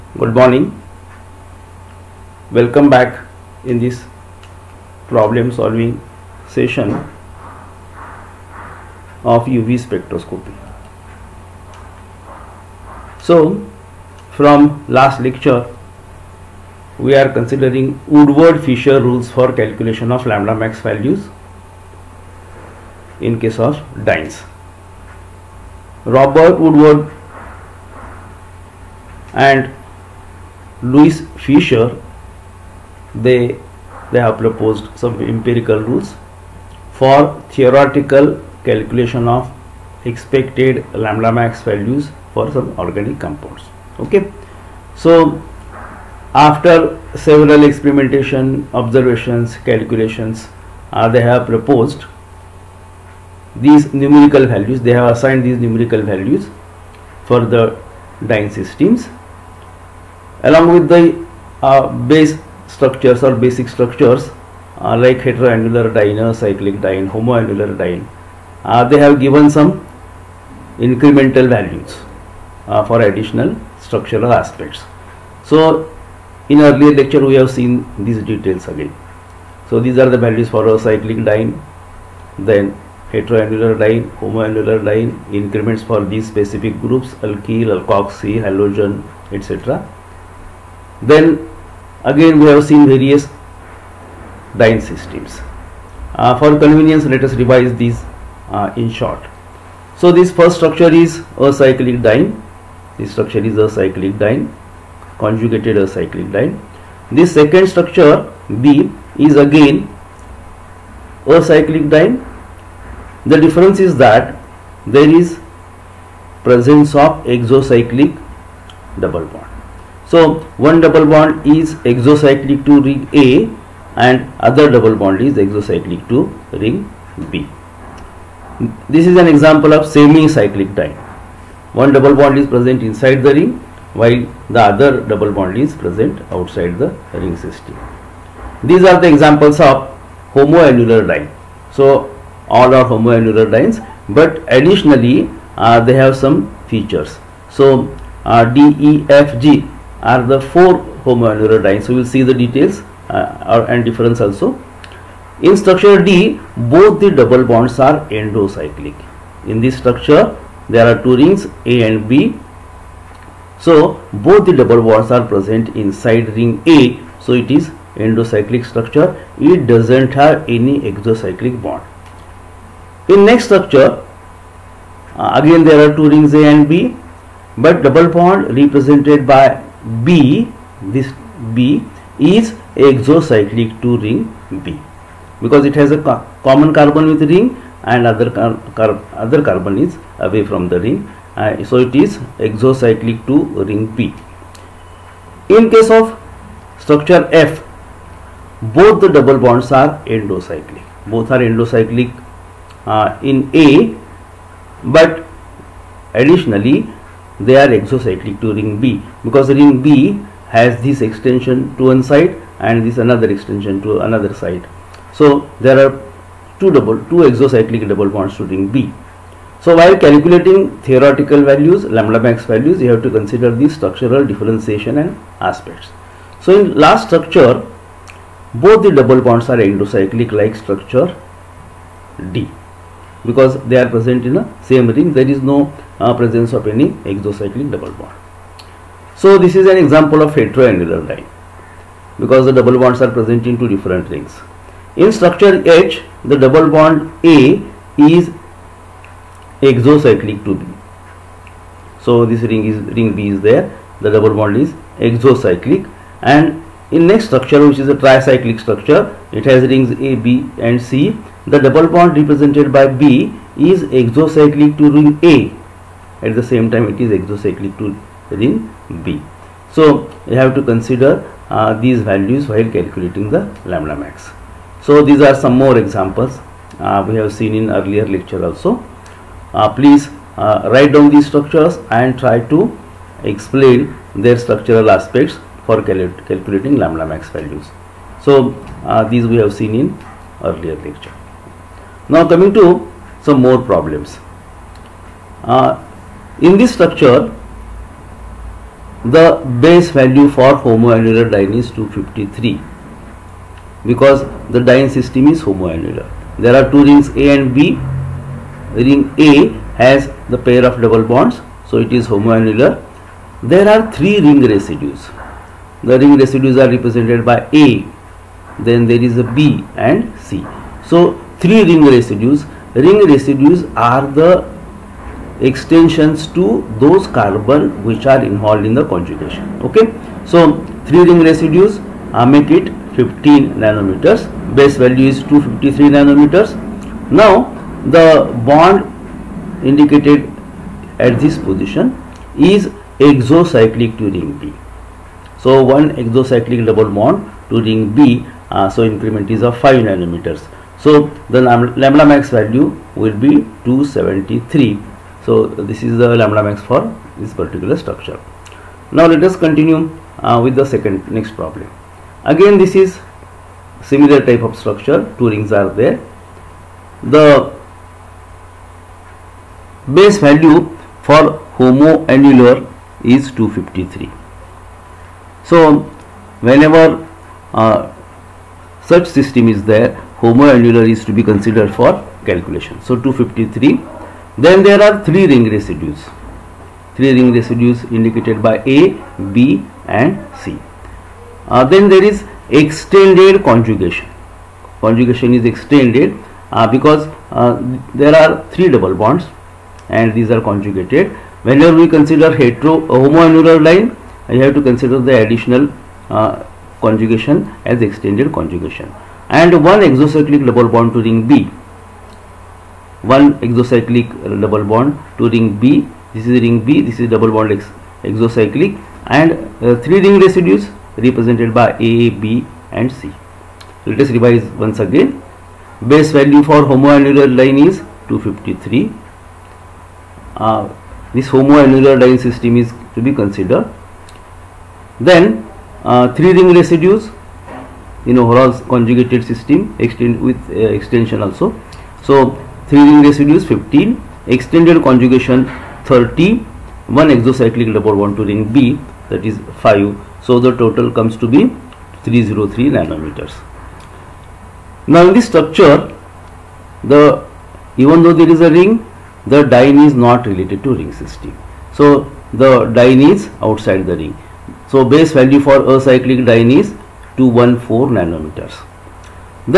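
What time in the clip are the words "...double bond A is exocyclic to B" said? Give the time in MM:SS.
04:06.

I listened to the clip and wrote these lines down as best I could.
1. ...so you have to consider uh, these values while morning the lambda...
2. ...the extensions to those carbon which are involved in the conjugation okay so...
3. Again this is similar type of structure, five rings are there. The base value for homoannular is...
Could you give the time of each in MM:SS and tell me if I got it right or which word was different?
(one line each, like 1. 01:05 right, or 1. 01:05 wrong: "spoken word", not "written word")
1. 04:29 wrong: "calculating", not "morning"
2. 05:24 right
3. 06:02 wrong: "two", not "five".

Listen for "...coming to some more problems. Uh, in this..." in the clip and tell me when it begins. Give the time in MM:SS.
04:52.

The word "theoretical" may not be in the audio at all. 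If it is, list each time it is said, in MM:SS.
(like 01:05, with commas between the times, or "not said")
00:37, 03:40.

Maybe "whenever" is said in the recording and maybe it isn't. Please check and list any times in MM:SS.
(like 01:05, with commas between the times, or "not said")
06:16, 06:41.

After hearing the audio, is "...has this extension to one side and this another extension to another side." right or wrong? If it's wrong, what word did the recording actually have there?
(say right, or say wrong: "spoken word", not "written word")
right.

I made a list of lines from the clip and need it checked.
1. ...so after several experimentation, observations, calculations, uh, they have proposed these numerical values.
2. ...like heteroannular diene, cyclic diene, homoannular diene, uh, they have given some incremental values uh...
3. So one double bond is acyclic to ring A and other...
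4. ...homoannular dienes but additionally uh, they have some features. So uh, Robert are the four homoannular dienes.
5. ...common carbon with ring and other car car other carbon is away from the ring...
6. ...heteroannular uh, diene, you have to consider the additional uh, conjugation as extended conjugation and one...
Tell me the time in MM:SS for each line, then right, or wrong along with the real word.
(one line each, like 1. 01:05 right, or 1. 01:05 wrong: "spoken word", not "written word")
1. 00:44 right
2. 01:05 right
3. 02:00 wrong: "exocyclic", not "acyclic"
4. 02:22 wrong: "DEFG", not "Robert"
5. 03:06 right
6. 06:42 wrong: "homoannular", not "heteroannular".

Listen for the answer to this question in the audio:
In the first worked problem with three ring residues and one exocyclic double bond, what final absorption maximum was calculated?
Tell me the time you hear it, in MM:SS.
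05:53.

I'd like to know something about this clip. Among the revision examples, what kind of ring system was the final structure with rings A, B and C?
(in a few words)
tricyclic.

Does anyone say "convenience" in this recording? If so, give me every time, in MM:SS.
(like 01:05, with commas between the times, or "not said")
01:36.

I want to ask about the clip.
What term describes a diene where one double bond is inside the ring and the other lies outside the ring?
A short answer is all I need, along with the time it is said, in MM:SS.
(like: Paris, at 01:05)
semi-cyclic diene, at 02:09.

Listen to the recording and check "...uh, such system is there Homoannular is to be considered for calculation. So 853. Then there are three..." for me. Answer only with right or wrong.
wrong.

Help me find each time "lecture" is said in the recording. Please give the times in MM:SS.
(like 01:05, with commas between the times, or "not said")
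00:15, 01:16, 04:38, 04:50.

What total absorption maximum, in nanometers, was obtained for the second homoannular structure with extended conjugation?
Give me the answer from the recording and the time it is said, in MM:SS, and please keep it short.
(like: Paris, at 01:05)
303, at 07:32.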